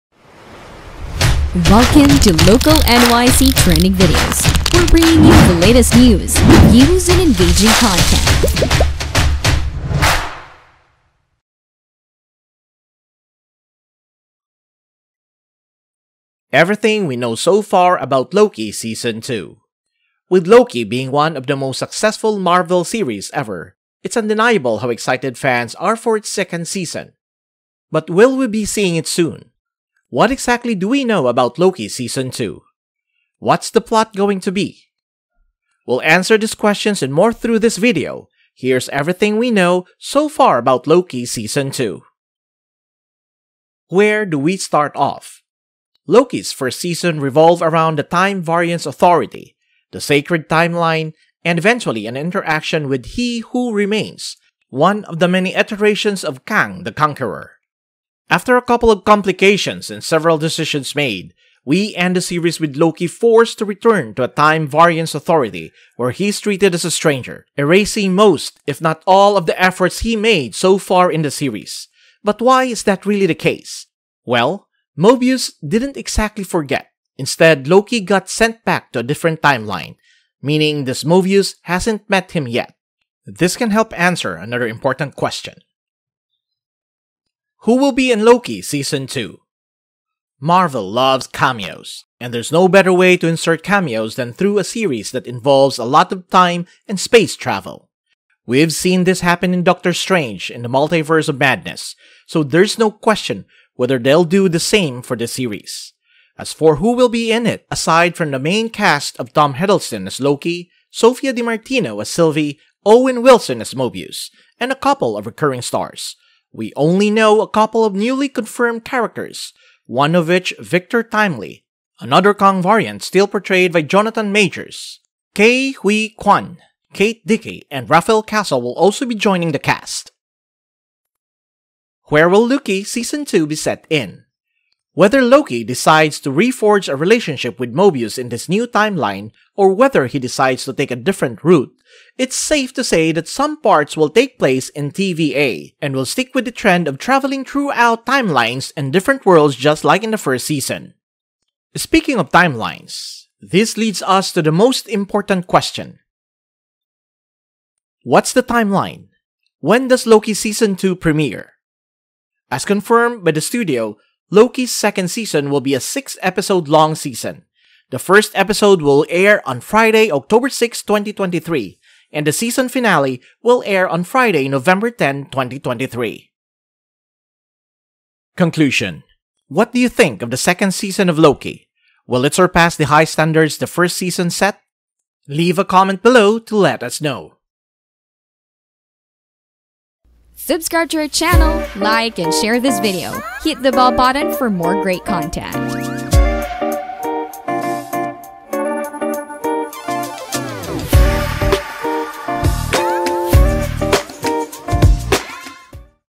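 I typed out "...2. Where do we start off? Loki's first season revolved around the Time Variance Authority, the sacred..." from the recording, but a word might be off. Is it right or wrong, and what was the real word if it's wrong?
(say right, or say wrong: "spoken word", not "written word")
right.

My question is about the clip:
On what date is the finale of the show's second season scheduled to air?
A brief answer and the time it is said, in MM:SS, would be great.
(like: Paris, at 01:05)
November 10, 2023, at 02:54.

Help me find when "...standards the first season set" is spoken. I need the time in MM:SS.
03:03.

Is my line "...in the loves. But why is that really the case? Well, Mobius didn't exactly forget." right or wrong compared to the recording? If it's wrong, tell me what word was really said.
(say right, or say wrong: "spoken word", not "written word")
wrong: "series", not "loves".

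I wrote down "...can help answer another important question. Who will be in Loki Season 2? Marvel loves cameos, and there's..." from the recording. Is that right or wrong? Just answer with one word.
right.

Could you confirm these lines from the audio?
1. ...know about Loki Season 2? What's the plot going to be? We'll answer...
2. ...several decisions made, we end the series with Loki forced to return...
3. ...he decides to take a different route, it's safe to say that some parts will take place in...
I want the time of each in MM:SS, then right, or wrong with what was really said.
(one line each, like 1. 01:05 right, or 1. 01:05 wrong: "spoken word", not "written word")
1. 00:31 right
2. 01:00 right
3. 02:20 right.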